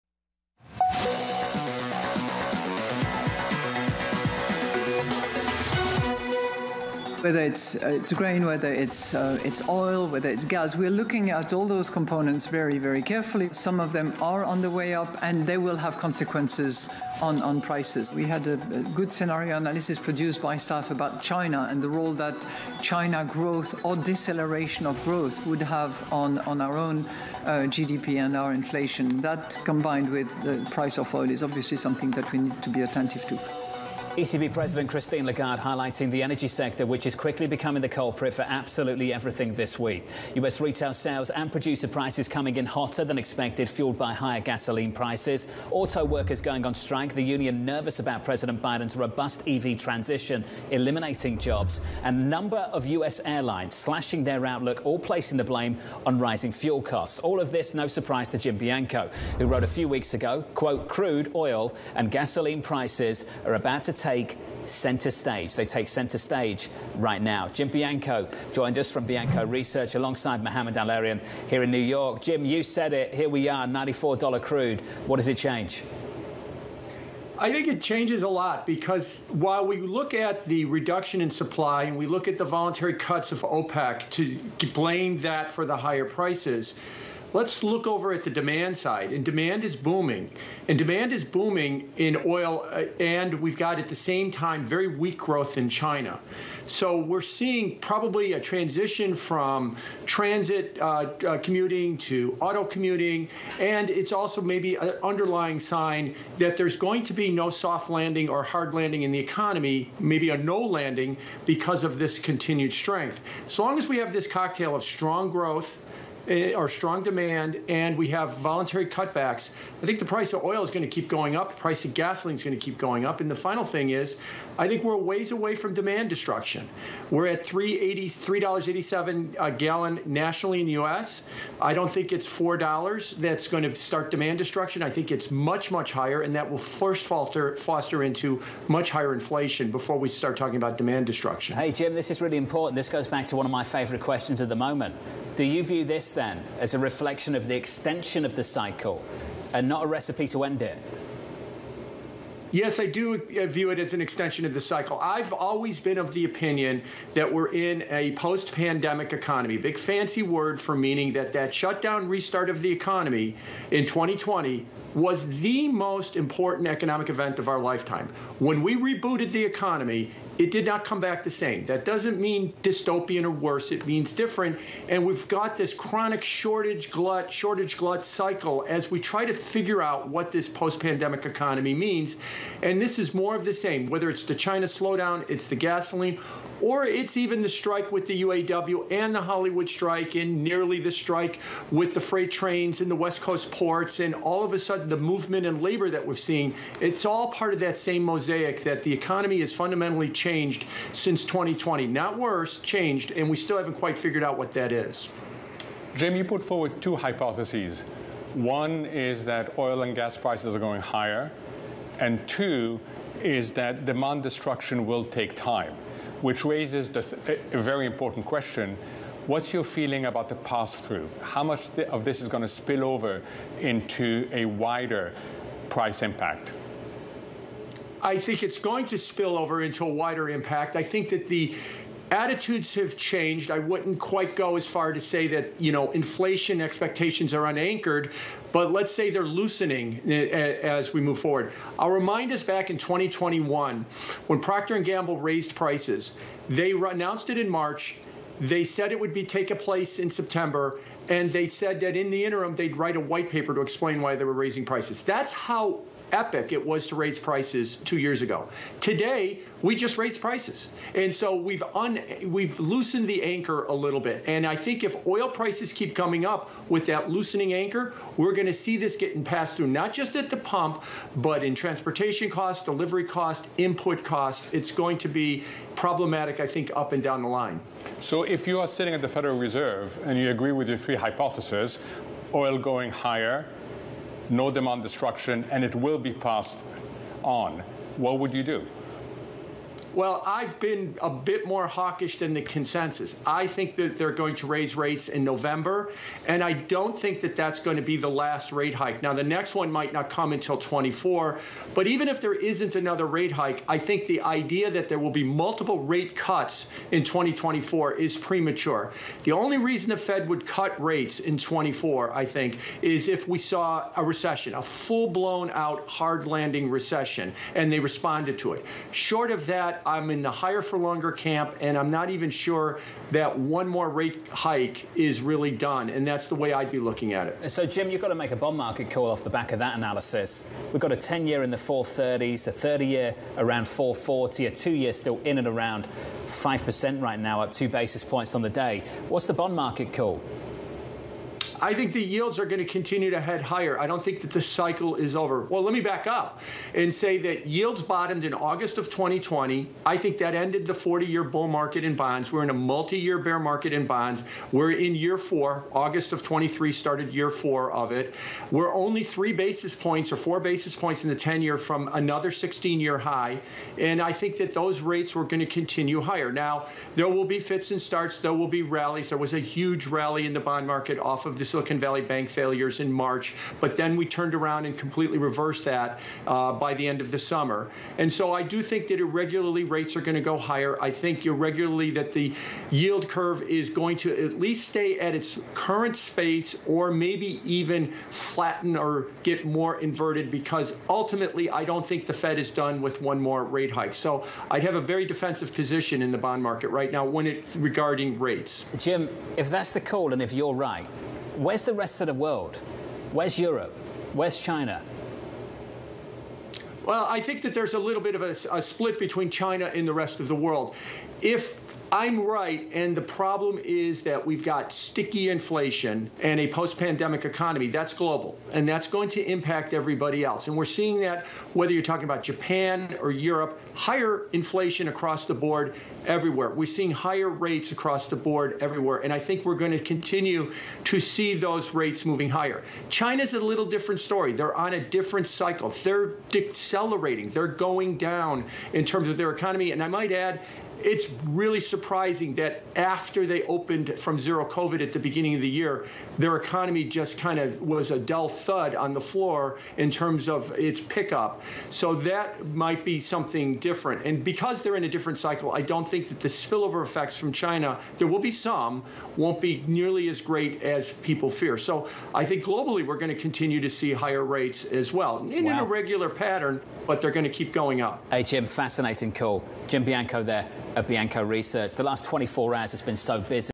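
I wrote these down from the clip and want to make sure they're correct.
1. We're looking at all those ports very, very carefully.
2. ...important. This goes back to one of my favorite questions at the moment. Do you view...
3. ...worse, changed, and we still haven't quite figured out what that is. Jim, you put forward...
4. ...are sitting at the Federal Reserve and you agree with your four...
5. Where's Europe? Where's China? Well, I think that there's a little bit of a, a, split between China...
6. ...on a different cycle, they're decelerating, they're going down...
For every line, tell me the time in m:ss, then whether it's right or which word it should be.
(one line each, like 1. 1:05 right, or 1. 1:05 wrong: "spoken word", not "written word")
1. 0:10 wrong: "components", not "ports"
2. 2:22 right
3. 3:22 right
4. 4:38 wrong: "three", not "four"
5. 6:43 right
6. 7:14 right.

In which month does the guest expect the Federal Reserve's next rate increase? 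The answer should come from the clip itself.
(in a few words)
November.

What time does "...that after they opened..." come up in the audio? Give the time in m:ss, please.
7:22.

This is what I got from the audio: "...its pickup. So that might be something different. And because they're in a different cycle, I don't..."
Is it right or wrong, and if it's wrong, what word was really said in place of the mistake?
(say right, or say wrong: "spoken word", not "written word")
right.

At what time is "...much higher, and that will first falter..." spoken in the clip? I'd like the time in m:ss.
2:15.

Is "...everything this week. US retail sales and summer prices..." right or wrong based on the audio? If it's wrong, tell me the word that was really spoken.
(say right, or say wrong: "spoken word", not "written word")
wrong: "producer", not "summer".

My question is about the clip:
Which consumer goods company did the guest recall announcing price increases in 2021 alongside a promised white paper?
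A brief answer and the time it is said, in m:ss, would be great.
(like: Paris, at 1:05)
Procter and Gamble, at 4:04.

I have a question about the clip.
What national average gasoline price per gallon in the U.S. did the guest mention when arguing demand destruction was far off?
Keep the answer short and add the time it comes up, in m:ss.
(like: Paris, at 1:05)
$3.87, at 2:07.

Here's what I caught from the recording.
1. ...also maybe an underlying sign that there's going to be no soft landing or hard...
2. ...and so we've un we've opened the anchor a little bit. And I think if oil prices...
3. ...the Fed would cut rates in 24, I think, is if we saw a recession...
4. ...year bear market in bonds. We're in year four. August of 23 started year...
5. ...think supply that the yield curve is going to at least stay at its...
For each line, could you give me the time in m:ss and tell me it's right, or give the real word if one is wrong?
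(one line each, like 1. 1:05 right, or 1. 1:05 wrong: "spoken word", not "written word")
1. 1:44 right
2. 4:20 wrong: "loosened", not "opened"
3. 5:09 right
4. 5:52 right
5. 6:20 wrong: "irregularly", not "supply".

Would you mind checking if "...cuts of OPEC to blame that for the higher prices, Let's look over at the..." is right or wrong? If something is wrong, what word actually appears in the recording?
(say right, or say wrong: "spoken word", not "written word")
right.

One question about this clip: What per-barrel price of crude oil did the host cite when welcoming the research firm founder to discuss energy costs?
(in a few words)
$94.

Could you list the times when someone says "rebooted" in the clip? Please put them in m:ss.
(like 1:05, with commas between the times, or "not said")
2:48.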